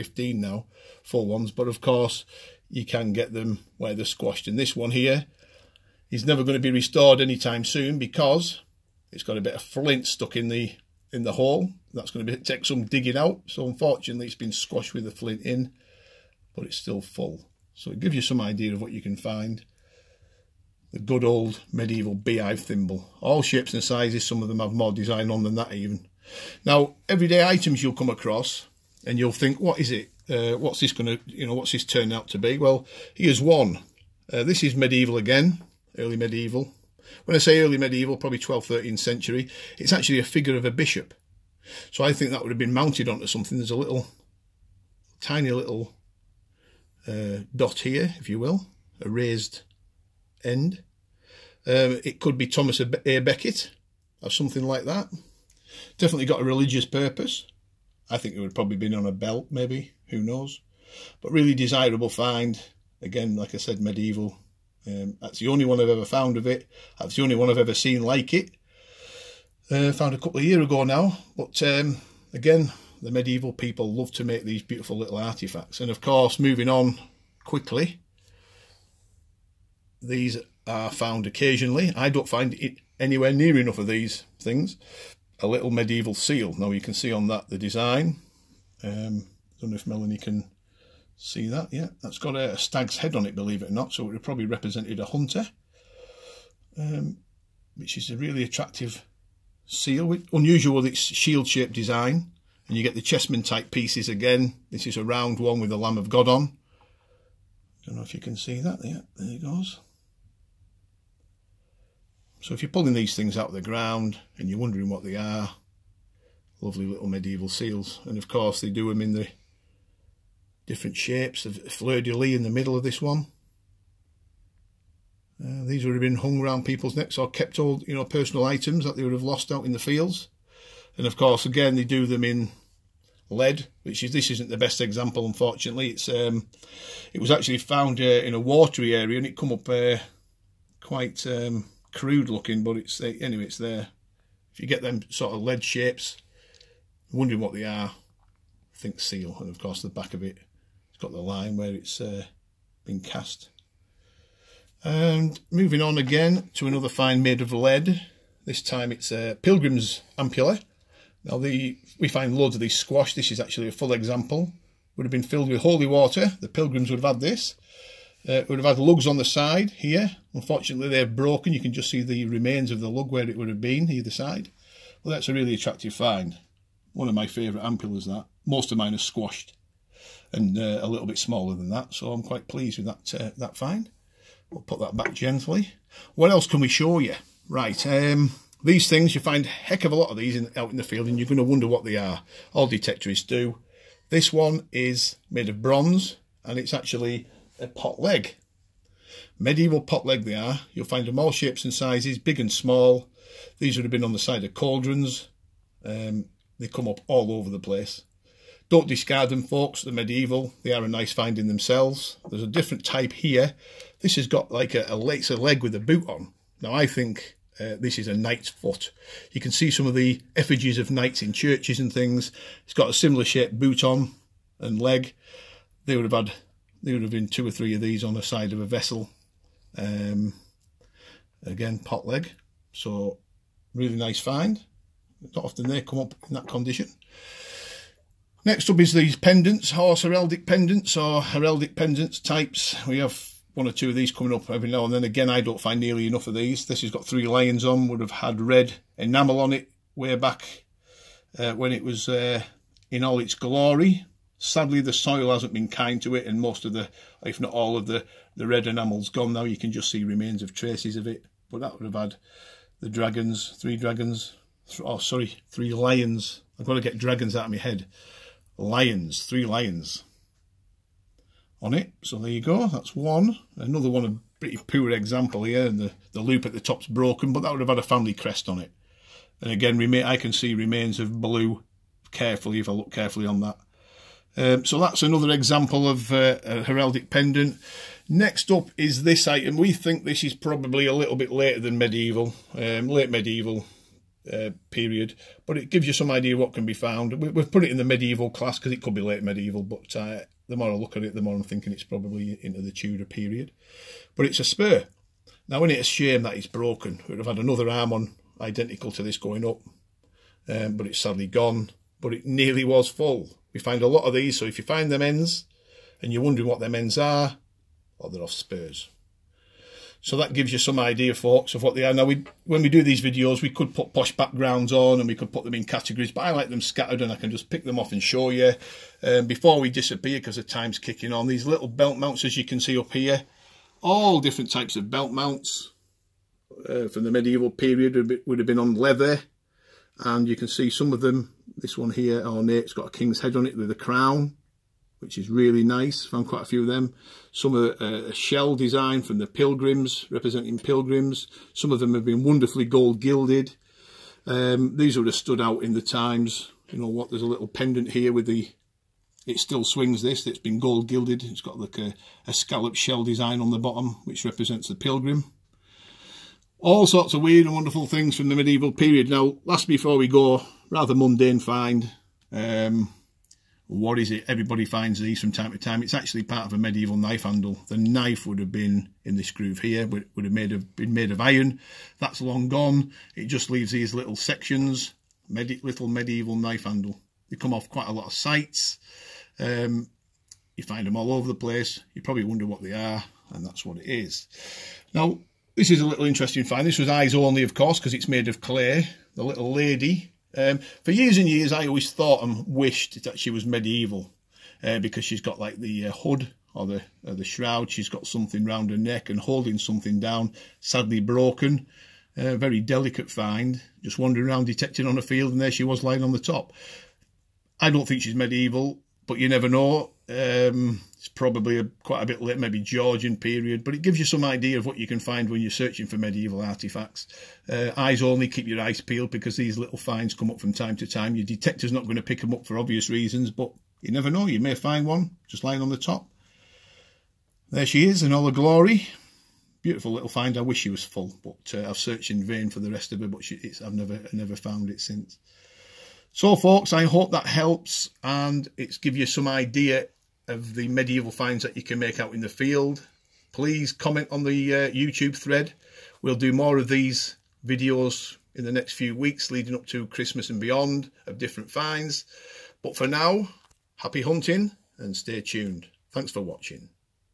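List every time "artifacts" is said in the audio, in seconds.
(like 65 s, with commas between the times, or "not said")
75 s, 426 s.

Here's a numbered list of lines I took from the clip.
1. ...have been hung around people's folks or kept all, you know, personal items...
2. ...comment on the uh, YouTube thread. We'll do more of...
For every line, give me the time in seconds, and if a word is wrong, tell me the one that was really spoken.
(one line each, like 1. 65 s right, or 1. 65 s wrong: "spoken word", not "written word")
1. 125 s wrong: "necks", not "folks"
2. 453 s right.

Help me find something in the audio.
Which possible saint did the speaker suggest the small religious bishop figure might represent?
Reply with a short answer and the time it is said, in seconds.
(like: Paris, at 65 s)
Thomas A. Becket, at 52 s.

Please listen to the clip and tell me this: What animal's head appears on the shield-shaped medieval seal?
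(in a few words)
Stag.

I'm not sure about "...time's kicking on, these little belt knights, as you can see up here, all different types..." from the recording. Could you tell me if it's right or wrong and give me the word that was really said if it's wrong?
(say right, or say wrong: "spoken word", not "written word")
wrong: "mounts", not "knights".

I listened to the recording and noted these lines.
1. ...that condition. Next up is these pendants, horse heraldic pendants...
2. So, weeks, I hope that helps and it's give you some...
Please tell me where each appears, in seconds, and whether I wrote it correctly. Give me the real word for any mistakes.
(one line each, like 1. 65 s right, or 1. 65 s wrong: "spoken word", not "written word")
1. 236 s right
2. 446 s wrong: "folks", not "weeks".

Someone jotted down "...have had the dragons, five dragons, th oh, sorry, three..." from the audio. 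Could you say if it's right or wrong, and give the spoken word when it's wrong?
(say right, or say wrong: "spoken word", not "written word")
wrong: "three", not "five".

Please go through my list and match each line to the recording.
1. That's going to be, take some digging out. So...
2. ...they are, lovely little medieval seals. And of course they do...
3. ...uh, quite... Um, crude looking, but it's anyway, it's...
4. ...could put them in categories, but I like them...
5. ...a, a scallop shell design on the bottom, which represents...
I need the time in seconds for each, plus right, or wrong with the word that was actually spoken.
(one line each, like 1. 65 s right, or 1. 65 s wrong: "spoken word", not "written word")
1. 11 s right
2. 115 s right
3. 139 s right
4. 325 s right
5. 361 s right.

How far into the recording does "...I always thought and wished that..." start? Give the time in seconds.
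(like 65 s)
401 s.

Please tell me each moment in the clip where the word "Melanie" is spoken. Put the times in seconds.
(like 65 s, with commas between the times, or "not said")
89 s.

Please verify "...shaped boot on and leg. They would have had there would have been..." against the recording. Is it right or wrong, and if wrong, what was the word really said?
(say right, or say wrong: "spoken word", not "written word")
right.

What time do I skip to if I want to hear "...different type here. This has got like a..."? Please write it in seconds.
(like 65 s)
212 s.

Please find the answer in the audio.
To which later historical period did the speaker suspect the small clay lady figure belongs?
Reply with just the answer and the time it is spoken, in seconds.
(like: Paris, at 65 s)
Georgian, at 422 s.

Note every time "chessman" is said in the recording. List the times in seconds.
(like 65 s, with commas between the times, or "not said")
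103 s.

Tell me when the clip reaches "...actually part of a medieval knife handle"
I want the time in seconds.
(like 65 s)
375 s.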